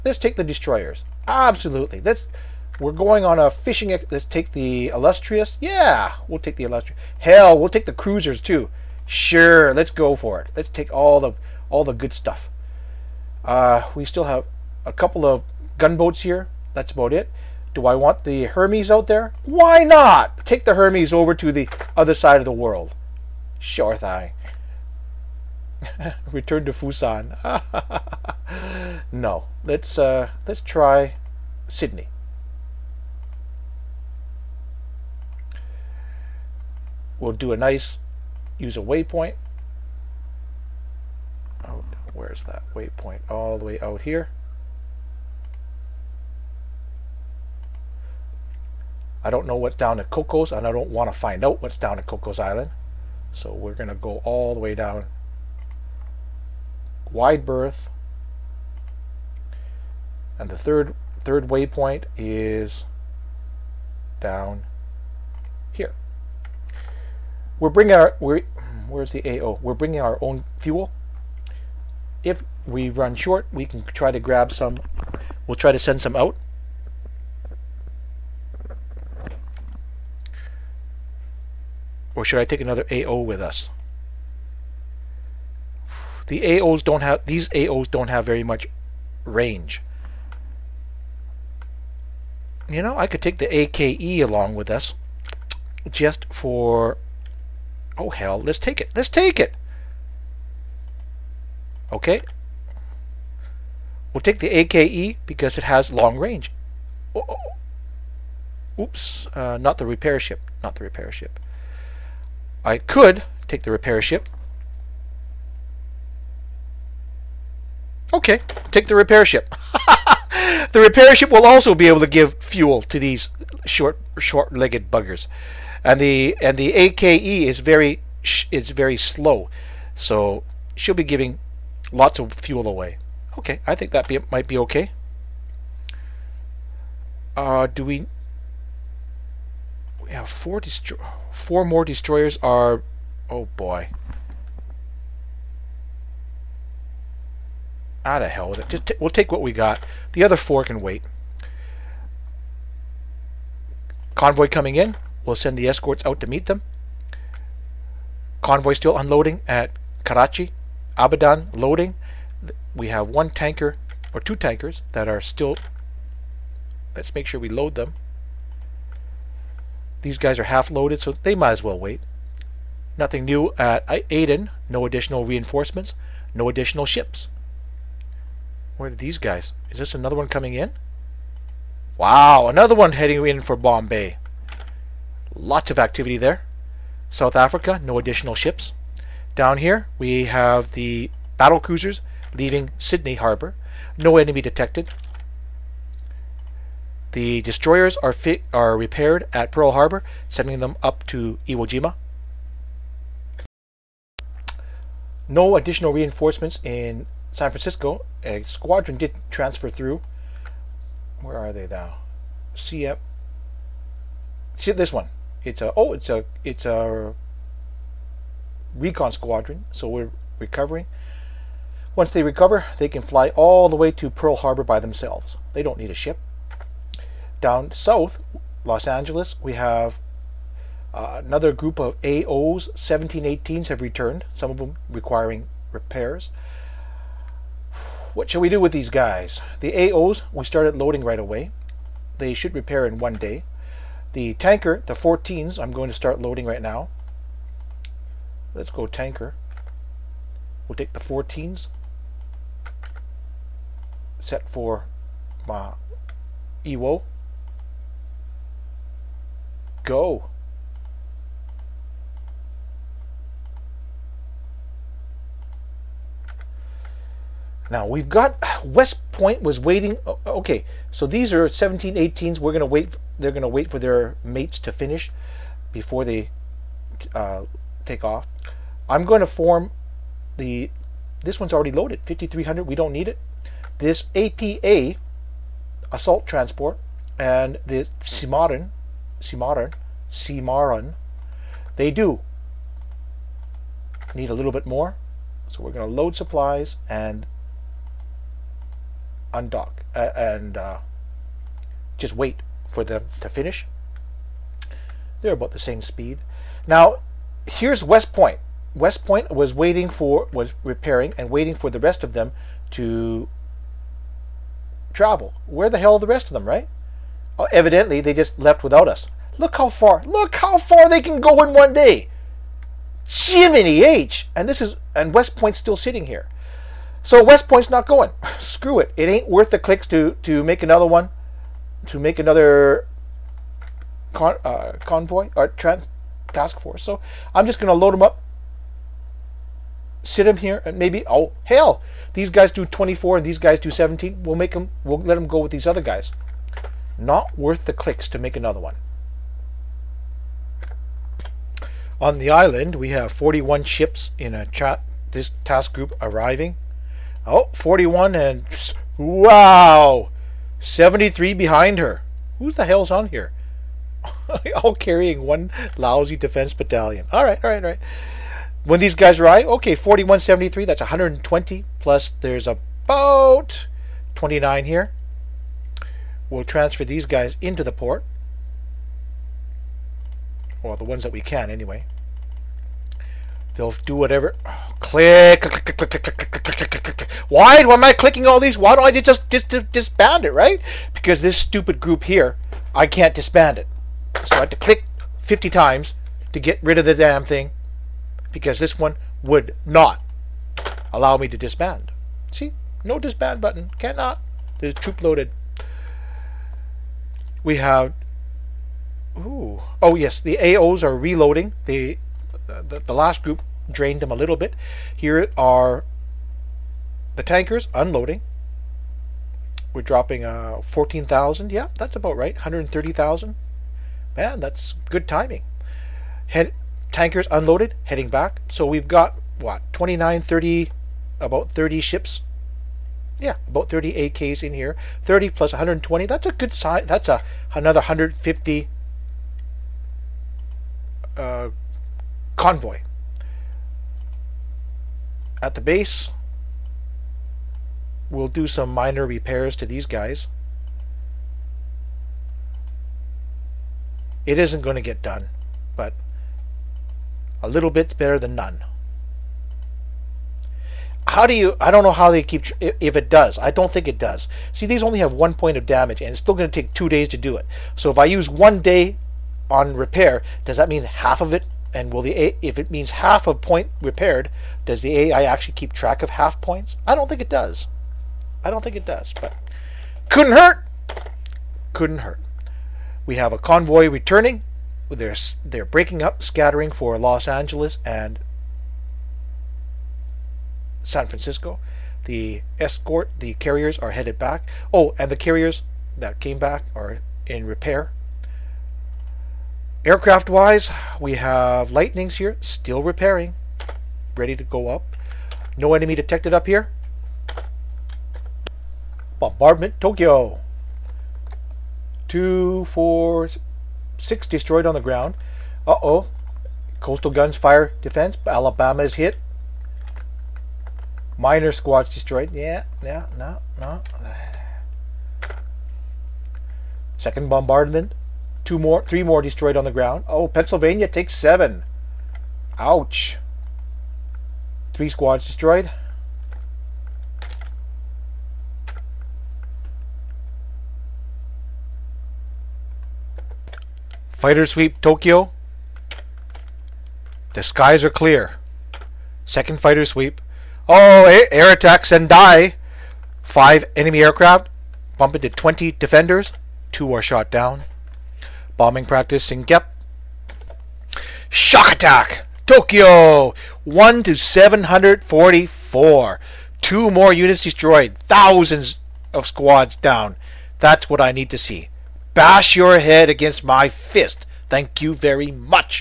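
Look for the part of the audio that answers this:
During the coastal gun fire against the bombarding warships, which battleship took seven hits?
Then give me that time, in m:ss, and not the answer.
8:50.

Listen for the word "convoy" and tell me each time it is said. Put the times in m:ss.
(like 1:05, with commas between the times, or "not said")
2:34, 2:38, 5:34, 7:22, 8:03.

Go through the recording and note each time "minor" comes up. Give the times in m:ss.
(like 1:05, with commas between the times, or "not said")
7:28, 8:41.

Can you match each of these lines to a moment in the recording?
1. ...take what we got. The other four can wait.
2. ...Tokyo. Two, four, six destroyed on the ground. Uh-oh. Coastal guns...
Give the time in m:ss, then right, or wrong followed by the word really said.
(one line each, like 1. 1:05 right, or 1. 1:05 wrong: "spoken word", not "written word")
1. 2:29 right
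2. 8:29 right.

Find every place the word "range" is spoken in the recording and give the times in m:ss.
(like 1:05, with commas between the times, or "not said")
1:29, 1:46.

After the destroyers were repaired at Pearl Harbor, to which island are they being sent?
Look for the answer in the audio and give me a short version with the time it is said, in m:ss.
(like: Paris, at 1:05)
Iwo Jima, at 3:21.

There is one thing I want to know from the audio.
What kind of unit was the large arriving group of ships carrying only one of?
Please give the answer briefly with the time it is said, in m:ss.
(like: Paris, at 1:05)
defense battalion, at 6:06.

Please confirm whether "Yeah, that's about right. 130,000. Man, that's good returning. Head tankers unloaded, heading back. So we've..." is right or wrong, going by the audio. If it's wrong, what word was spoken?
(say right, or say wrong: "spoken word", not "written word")
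wrong: "timing", not "returning".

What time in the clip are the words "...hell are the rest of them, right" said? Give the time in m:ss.
5:15.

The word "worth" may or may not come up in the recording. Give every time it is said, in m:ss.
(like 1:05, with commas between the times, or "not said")
5:29, 5:47.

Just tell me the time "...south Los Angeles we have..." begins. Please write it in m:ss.
3:47.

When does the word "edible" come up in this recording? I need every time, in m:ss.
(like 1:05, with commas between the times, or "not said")
not said.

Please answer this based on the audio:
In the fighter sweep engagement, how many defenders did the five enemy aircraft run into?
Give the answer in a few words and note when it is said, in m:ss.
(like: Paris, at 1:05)
20, at 9:15.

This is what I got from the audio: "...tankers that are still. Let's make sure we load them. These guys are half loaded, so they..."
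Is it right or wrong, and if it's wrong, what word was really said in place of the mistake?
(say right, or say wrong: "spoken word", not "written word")
right.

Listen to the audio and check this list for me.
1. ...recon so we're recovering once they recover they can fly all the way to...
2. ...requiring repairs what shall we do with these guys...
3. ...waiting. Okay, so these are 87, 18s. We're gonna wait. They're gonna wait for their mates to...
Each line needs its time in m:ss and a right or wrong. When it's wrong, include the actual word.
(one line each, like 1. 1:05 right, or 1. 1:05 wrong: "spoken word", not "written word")
1. 3:39 wrong: "squadron", not "recon"
2. 3:54 right
3. 4:29 wrong: "17", not "87".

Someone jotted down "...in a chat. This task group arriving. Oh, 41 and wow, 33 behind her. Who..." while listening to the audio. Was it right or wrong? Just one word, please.
wrong.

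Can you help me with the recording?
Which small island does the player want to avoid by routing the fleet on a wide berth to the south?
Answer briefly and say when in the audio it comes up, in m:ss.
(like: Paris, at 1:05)
Cocos Island, at 0:52.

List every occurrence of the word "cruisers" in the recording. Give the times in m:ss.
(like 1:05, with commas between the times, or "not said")
0:07, 3:11.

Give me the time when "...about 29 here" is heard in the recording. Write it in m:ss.
6:12.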